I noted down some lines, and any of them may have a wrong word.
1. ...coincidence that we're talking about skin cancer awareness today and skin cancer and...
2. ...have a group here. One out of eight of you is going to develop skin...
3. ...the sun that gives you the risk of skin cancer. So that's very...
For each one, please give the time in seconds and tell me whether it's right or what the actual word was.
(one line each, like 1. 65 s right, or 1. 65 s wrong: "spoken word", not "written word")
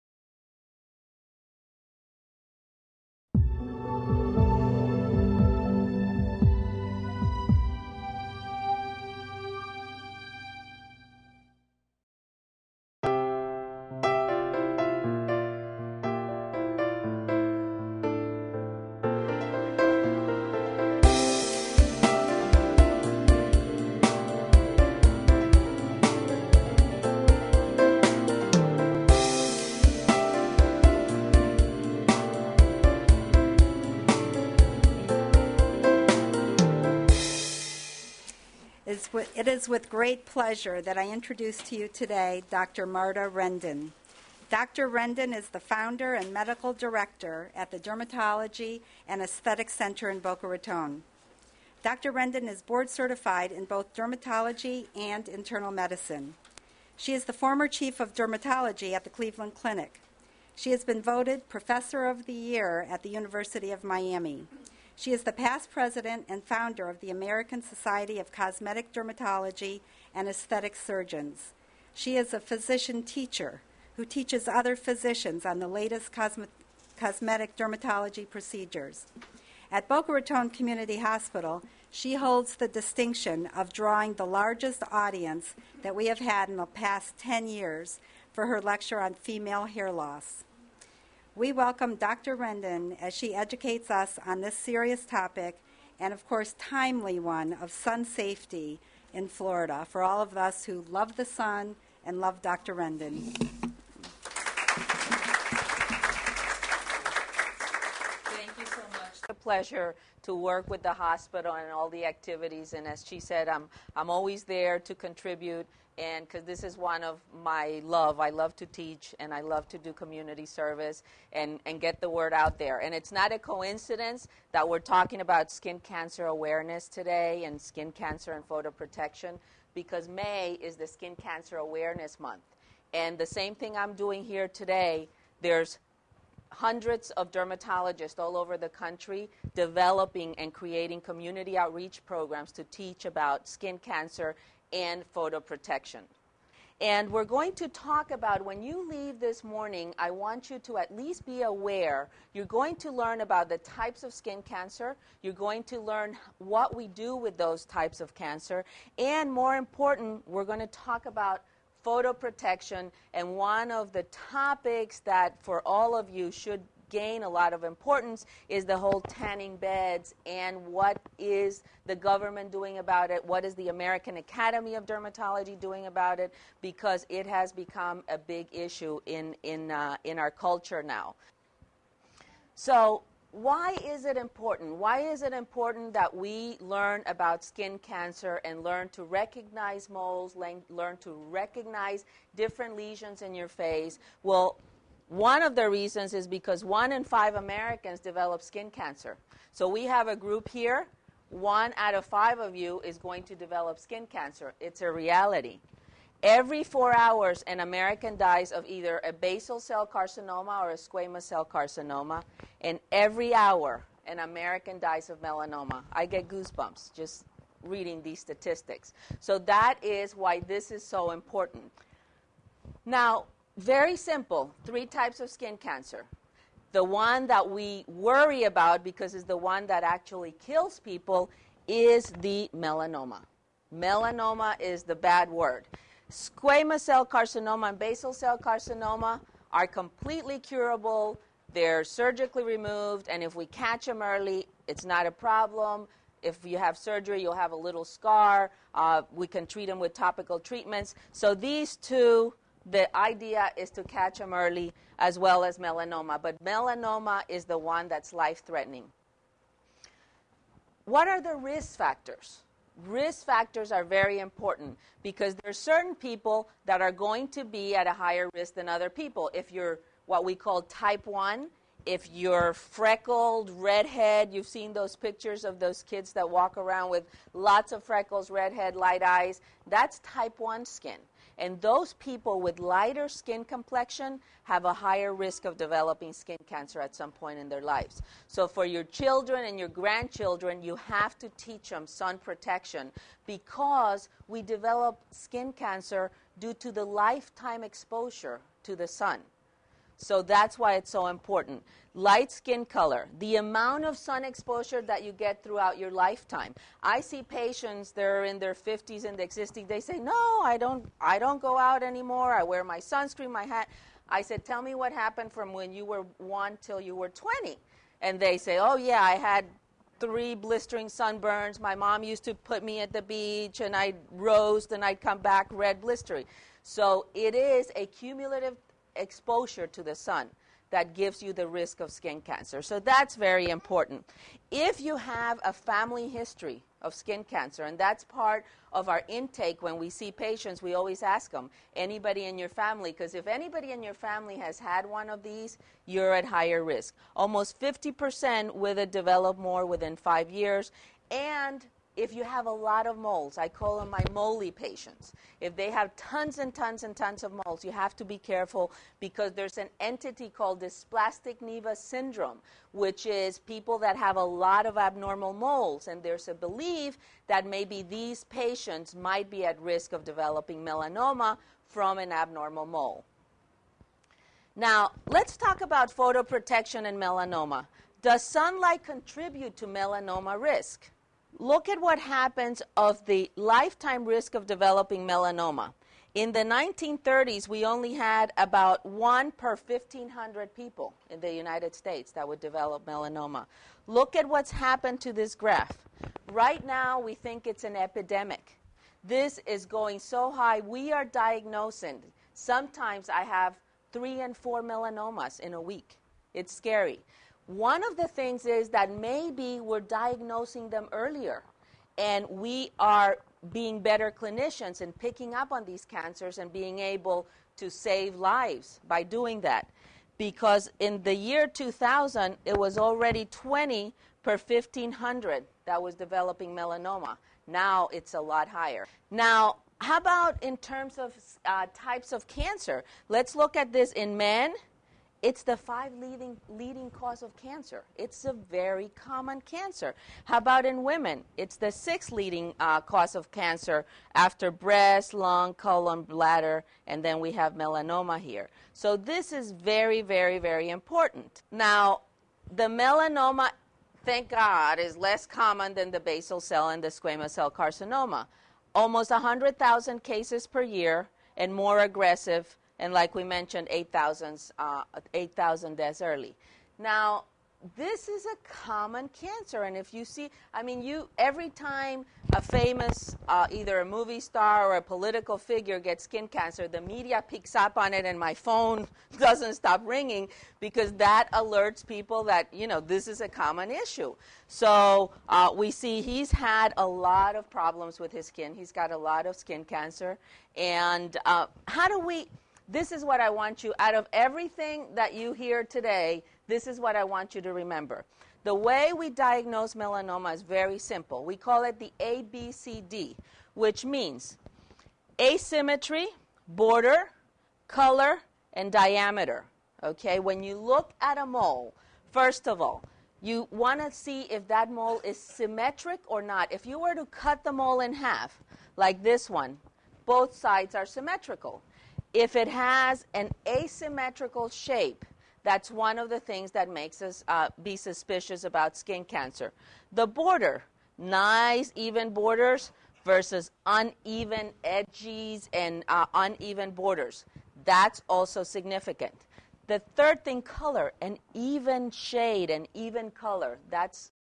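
1. 123 s right
2. 199 s wrong: "five", not "eight"
3. 329 s right.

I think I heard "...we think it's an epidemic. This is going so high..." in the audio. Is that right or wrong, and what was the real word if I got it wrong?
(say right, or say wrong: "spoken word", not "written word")
right.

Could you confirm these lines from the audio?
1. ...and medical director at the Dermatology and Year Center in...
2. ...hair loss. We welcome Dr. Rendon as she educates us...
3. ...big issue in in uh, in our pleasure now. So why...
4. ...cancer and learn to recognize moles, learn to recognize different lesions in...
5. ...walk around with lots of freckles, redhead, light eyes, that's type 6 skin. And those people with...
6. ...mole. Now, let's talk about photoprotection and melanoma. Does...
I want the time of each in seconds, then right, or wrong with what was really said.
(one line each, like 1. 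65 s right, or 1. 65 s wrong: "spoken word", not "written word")
1. 46 s wrong: "Aesthetic", not "Year"
2. 89 s right
3. 178 s wrong: "culture", not "pleasure"
4. 187 s right
5. 276 s wrong: "1", not "6"
6. 372 s right.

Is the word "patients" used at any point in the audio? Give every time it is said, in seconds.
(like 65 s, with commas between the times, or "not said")
307 s, 340 s, 354 s, 368 s.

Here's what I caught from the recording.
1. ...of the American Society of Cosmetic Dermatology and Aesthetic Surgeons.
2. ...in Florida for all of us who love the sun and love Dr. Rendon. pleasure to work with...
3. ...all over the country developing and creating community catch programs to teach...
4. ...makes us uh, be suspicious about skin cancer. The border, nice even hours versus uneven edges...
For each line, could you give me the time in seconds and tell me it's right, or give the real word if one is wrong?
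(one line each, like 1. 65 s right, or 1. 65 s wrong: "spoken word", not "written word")
1. 66 s right
2. 99 s right
3. 138 s wrong: "outreach", not "catch"
4. 526 s wrong: "borders", not "hours".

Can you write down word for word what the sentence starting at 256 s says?
But melanoma is the one that's life threatening.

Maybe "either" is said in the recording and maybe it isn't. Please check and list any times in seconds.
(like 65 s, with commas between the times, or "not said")
208 s, 473 s.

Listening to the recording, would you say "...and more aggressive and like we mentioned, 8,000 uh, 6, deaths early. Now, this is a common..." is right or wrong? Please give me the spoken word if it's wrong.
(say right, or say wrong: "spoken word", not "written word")
wrong: "8", not "6".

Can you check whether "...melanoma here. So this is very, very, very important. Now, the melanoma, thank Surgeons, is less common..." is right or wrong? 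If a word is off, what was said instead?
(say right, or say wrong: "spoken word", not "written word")
wrong: "God", not "Surgeons".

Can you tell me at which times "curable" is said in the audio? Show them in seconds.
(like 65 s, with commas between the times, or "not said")
240 s.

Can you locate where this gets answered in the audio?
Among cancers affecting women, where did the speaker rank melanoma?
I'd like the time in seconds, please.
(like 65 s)
441 s.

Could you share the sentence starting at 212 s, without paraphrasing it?
And every hour, an American dies of melanoma.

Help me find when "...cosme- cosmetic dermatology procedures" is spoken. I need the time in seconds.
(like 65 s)
76 s.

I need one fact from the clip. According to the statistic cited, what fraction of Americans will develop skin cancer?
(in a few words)
1 in 5.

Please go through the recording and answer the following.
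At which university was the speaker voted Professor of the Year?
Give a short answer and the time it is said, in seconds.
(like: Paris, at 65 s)
University of Miami, at 63 s.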